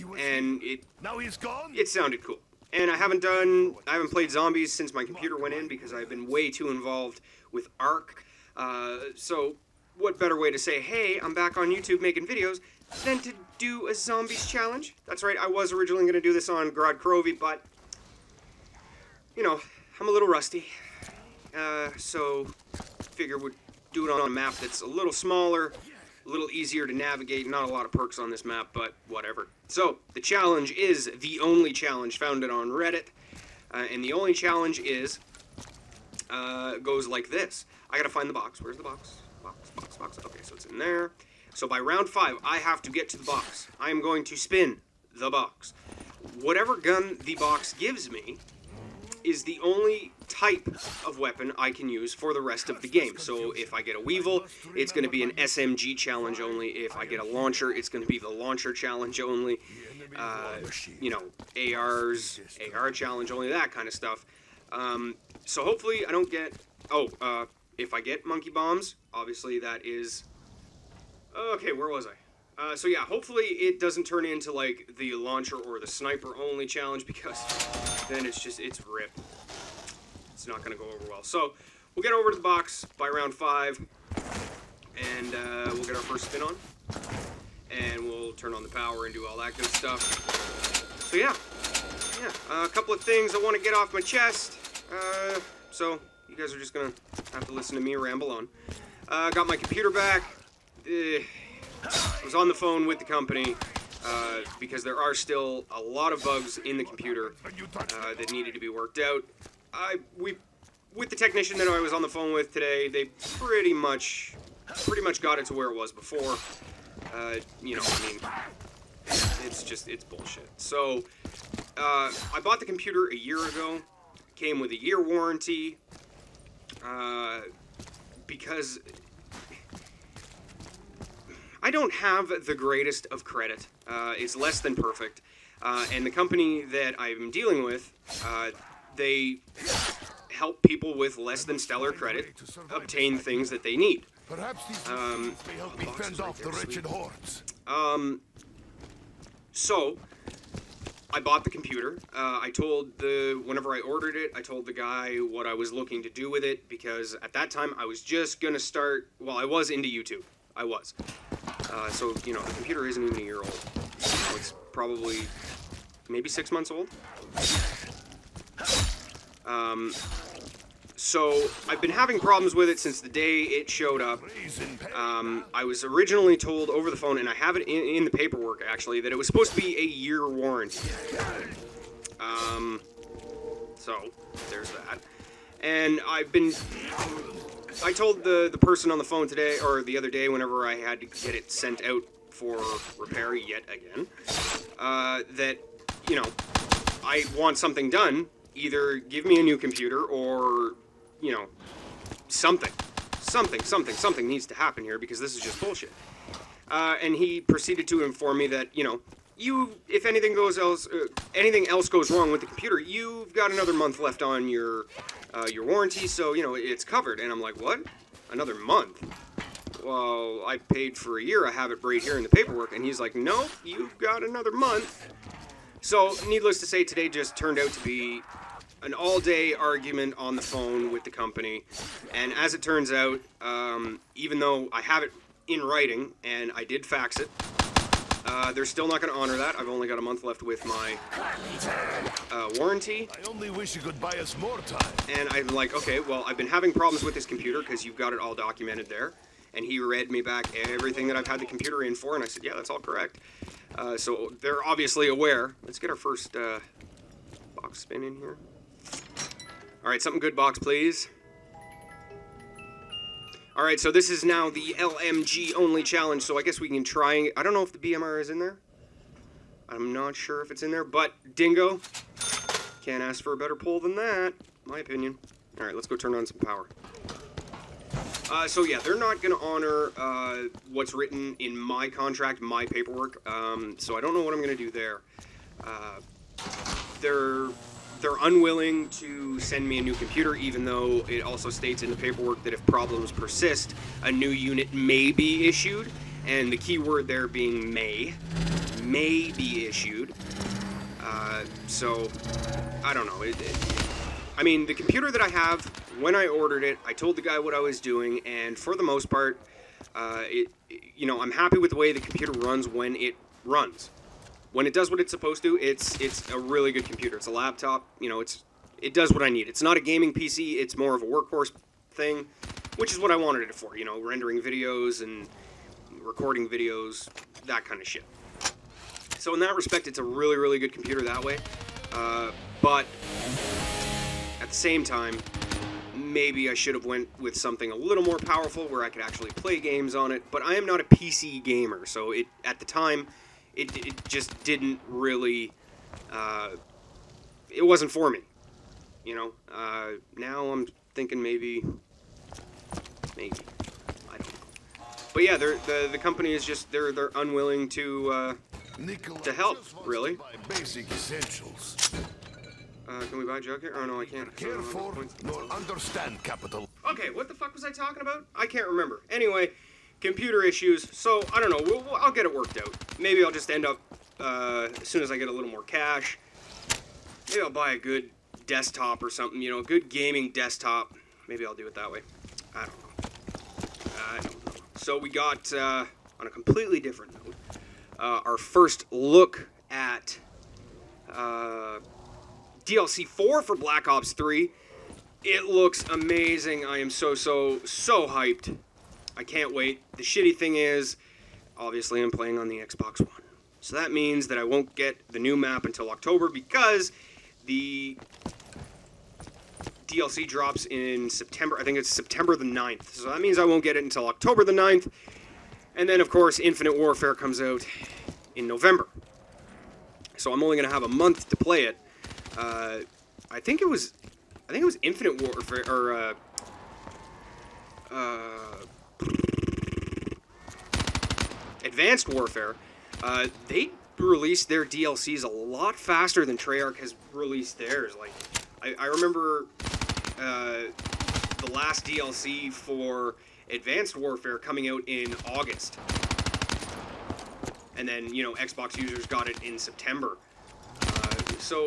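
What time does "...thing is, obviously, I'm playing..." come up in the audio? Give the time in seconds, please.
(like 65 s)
400 s.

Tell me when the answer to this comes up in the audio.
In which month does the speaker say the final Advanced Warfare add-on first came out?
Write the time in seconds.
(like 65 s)
445 s.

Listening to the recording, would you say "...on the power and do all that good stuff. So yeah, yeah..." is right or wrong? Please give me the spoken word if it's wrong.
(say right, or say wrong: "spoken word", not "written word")
right.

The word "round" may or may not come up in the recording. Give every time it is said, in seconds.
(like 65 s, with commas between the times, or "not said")
41 s, 83 s.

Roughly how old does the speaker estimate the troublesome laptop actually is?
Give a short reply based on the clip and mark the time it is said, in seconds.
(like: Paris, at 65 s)
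6 months, at 166 s.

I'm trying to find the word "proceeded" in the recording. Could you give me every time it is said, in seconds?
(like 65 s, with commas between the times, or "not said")
207 s.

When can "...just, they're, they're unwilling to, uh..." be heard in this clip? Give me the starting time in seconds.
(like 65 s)
356 s.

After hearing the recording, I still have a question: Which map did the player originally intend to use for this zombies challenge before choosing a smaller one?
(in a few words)
Gorod Krovi.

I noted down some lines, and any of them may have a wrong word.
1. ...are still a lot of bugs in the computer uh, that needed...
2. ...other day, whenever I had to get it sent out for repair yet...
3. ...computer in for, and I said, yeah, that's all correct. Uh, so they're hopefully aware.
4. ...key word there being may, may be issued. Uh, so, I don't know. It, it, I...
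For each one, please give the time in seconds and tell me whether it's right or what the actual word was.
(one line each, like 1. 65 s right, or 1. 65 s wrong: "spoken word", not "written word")
1. 104 s right
2. 189 s right
3. 251 s wrong: "obviously", not "hopefully"
4. 296 s right.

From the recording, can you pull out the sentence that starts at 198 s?
Either give me a new computer or, you know, something.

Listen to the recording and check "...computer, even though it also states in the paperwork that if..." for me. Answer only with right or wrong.
right.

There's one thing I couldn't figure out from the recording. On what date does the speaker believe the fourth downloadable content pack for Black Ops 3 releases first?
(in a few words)
September 9th.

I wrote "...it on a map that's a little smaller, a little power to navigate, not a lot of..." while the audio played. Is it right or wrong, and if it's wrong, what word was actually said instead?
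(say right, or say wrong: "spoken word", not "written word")
wrong: "easier", not "power".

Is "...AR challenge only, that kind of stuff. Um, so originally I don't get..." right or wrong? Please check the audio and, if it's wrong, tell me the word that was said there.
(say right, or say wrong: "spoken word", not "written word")
wrong: "hopefully", not "originally".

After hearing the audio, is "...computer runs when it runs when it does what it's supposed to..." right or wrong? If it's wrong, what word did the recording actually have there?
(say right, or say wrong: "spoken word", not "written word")
right.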